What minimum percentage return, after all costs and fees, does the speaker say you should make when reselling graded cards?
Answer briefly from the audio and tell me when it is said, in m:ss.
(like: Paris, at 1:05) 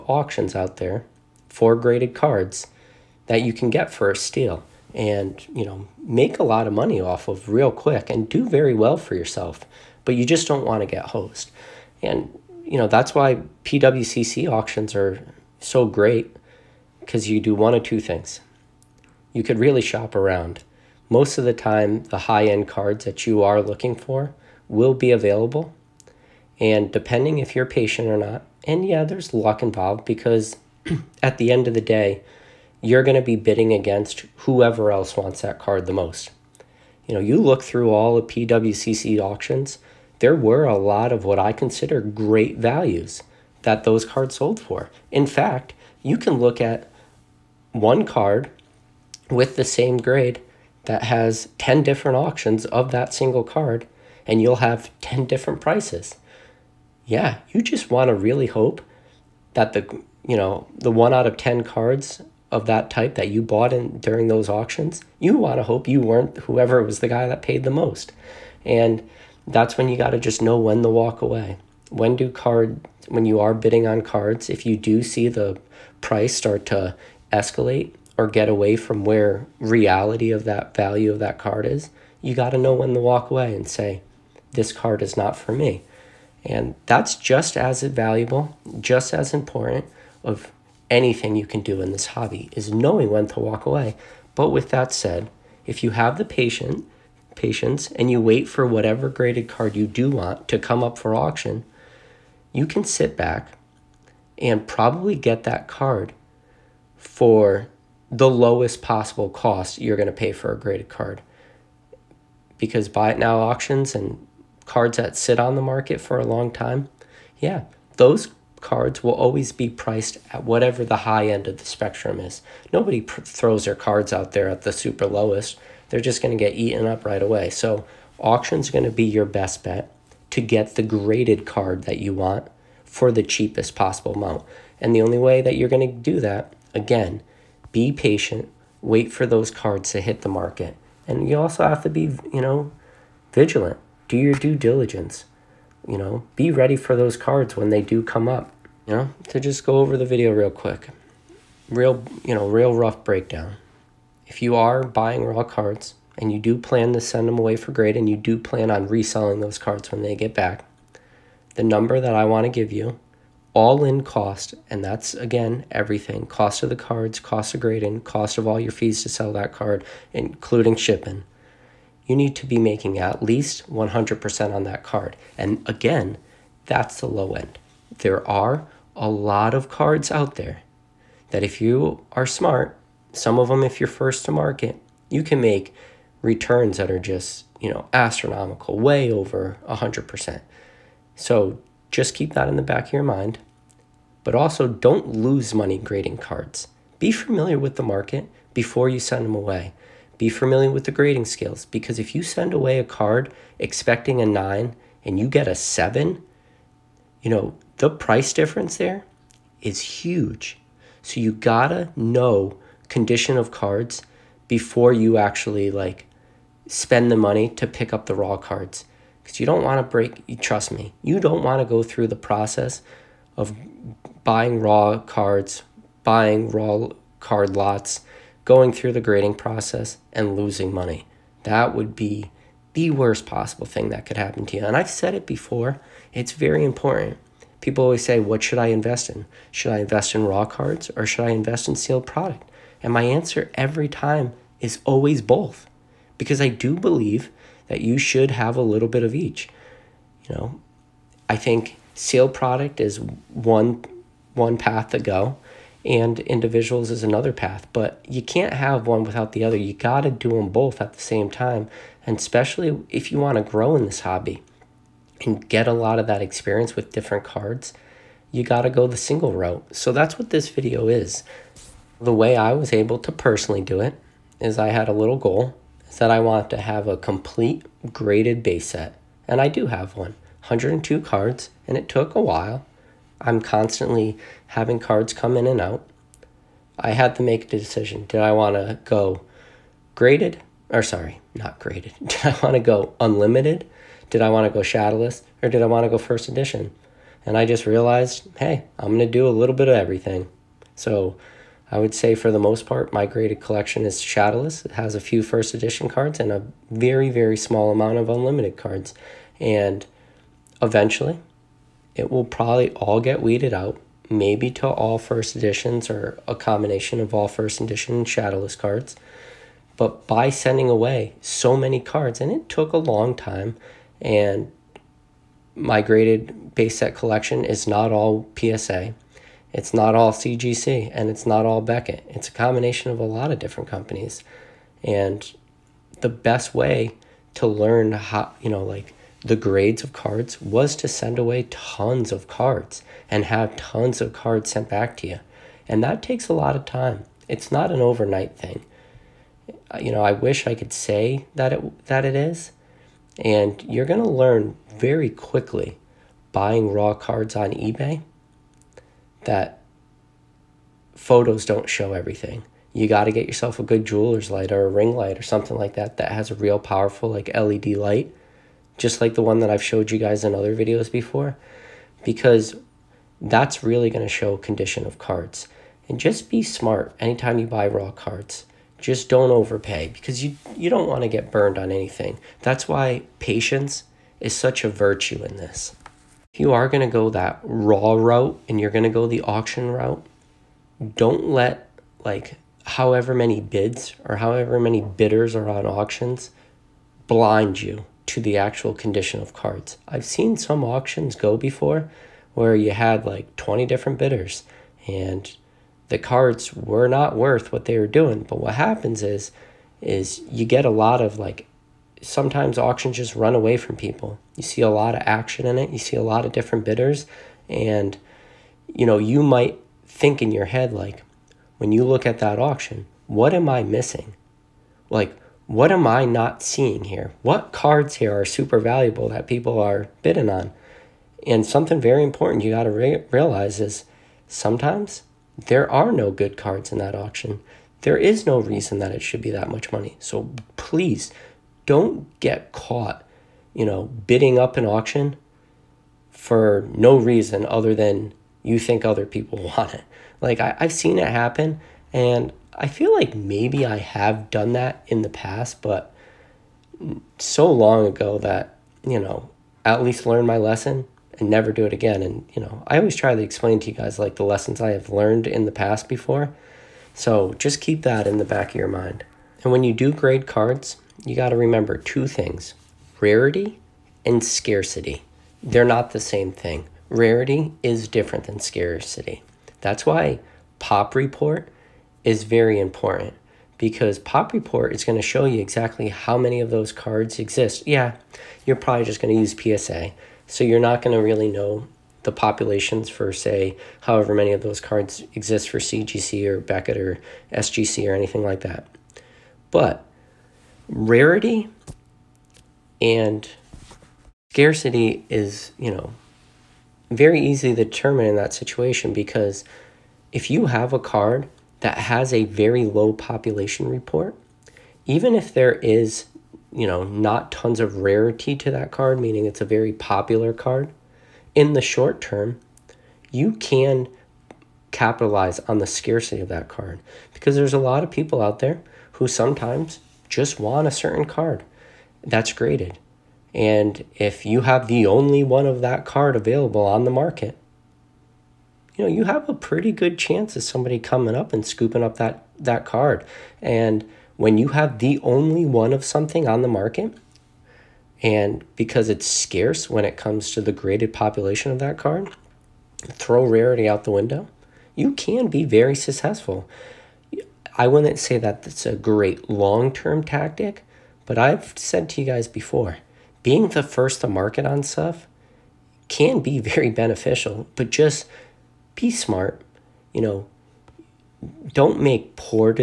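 100%, at 2:52.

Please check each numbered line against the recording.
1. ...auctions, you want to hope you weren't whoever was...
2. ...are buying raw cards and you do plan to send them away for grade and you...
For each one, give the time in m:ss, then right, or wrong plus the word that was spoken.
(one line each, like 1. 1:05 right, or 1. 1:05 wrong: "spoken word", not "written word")
1. 1:04 right
2. 2:34 right.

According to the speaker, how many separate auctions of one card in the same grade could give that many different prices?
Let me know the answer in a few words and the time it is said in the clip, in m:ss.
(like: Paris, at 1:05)
10, at 0:51.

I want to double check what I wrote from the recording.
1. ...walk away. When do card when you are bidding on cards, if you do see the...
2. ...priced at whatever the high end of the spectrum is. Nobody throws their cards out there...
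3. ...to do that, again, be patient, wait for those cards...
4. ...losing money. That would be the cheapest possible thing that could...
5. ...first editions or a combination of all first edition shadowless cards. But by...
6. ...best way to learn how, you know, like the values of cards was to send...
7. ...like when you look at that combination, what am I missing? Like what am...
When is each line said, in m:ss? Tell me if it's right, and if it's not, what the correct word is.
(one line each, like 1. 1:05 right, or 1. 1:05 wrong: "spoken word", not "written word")
1. 1:10 right
2. 1:59 right
3. 2:15 right
4. 3:50 wrong: "worst", not "cheapest"
5. 5:14 right
6. 5:36 wrong: "grades", not "values"
7. 7:00 wrong: "auction", not "combination".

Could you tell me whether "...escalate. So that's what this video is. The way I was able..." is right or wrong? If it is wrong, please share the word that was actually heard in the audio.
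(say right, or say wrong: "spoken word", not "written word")
wrong: "route", not "escalate".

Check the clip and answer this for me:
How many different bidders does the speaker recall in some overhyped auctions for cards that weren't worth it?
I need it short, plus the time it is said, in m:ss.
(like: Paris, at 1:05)
20, at 6:43.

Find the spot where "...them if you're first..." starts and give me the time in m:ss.
3:03.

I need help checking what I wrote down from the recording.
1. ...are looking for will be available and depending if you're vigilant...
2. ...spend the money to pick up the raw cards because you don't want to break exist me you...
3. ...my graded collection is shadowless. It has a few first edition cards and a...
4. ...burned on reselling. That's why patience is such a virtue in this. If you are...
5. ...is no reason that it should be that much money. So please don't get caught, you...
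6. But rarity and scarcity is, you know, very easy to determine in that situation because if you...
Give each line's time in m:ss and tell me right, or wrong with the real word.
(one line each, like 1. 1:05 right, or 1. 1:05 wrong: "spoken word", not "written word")
1. 0:23 wrong: "patient", not "vigilant"
2. 3:36 wrong: "trust", not "exist"
3. 5:02 right
4. 6:21 wrong: "anything", not "reselling"
5. 7:17 right
6. 8:19 right.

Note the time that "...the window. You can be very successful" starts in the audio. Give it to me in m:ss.
9:13.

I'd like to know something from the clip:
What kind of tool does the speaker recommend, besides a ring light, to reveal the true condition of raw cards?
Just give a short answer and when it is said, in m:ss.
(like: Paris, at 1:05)
Jeweler's light, at 6:03.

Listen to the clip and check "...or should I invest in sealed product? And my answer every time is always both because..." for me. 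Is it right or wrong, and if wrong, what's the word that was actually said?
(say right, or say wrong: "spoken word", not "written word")
right.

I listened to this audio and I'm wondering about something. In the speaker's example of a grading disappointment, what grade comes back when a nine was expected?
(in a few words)
7.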